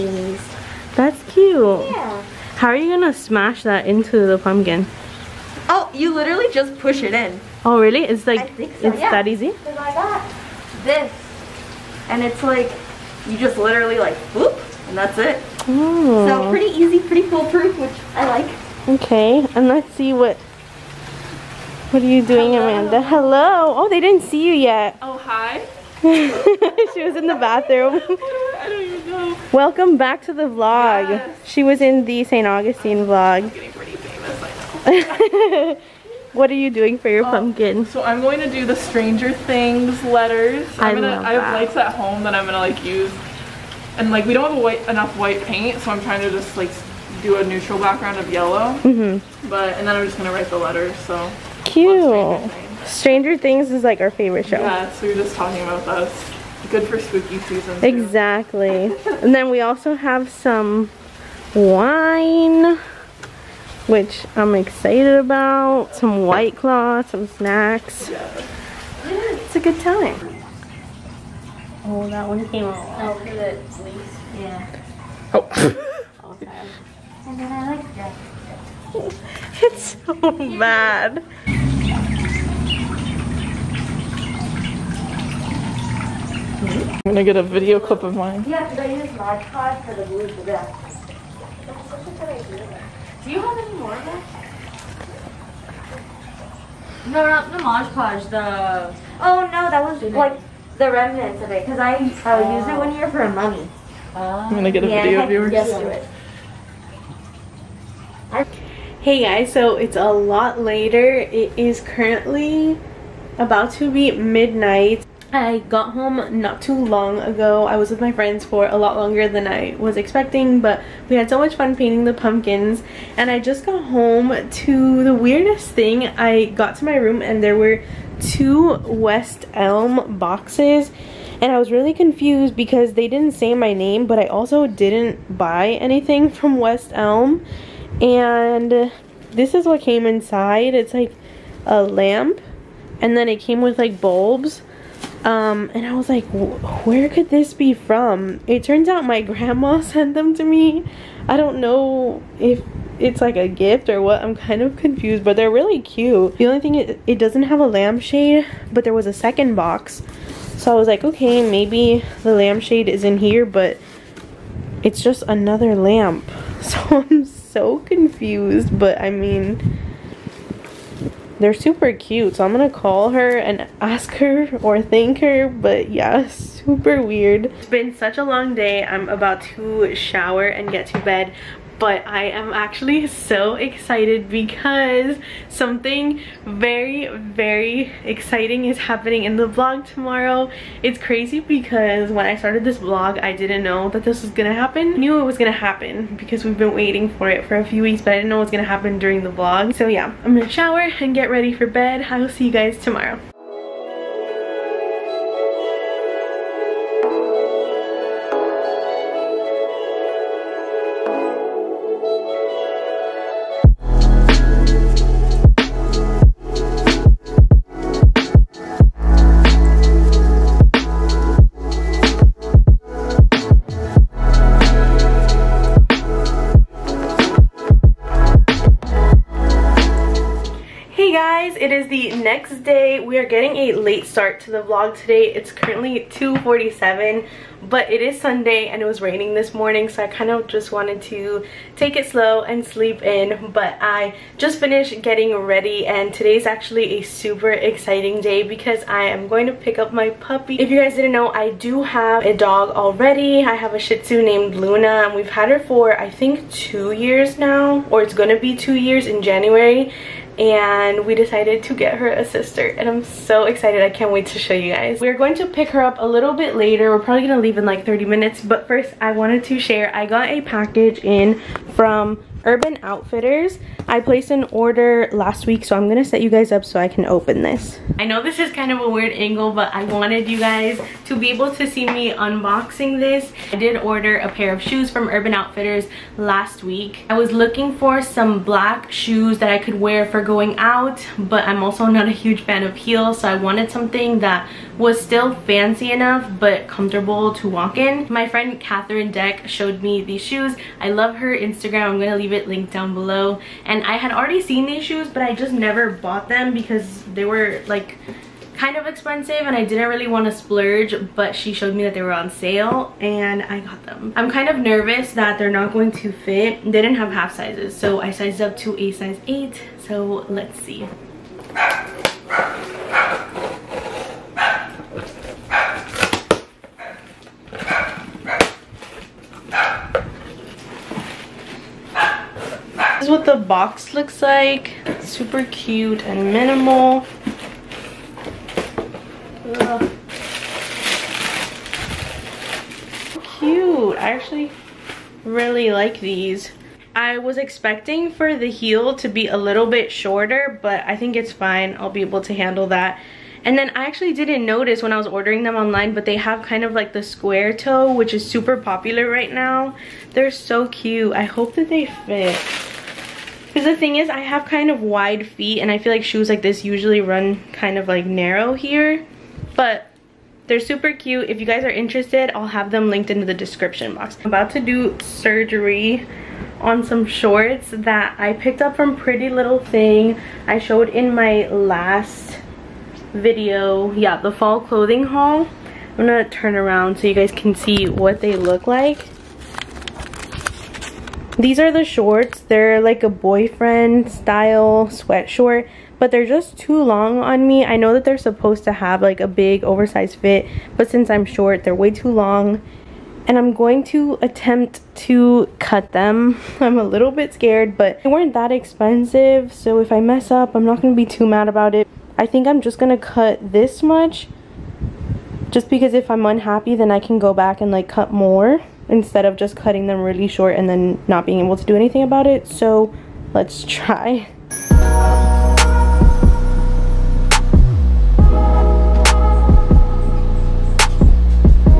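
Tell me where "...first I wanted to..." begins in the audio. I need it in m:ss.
4:28.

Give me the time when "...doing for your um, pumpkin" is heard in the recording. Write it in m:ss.
0:36.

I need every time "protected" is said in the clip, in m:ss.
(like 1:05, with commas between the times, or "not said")
not said.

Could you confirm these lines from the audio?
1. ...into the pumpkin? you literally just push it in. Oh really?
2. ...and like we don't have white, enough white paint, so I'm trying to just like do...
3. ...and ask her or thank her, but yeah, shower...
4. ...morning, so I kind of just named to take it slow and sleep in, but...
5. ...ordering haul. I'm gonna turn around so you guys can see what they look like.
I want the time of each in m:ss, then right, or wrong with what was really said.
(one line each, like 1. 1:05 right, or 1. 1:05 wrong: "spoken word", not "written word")
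1. 0:03 right
2. 0:43 right
3. 2:53 wrong: "super", not "shower"
4. 3:59 wrong: "wanted", not "named"
5. 6:24 wrong: "clothing", not "ordering".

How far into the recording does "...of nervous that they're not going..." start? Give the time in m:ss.
5:14.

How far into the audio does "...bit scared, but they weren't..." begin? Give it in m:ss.
6:47.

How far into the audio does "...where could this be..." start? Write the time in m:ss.
2:26.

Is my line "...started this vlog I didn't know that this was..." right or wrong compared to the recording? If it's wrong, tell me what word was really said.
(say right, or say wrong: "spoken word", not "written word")
right.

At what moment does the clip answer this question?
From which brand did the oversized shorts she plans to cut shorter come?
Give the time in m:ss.
6:18.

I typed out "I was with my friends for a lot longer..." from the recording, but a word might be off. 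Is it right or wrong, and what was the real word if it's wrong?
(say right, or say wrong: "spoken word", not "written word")
right.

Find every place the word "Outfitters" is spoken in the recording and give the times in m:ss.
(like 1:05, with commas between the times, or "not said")
4:32, 4:45.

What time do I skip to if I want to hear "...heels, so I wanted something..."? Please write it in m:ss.
4:52.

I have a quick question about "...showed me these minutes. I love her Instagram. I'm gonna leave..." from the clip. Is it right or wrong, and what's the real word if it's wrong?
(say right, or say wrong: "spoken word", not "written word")
wrong: "shoes", not "minutes".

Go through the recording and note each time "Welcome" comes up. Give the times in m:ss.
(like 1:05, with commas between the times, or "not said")
0:29.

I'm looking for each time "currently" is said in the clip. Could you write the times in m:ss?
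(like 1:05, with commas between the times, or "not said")
1:51, 3:55.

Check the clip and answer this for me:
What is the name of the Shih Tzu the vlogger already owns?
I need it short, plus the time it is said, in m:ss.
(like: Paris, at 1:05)
Luna, at 4:14.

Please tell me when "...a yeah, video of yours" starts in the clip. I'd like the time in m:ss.
1:44.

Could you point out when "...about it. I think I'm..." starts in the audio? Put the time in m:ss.
6:51.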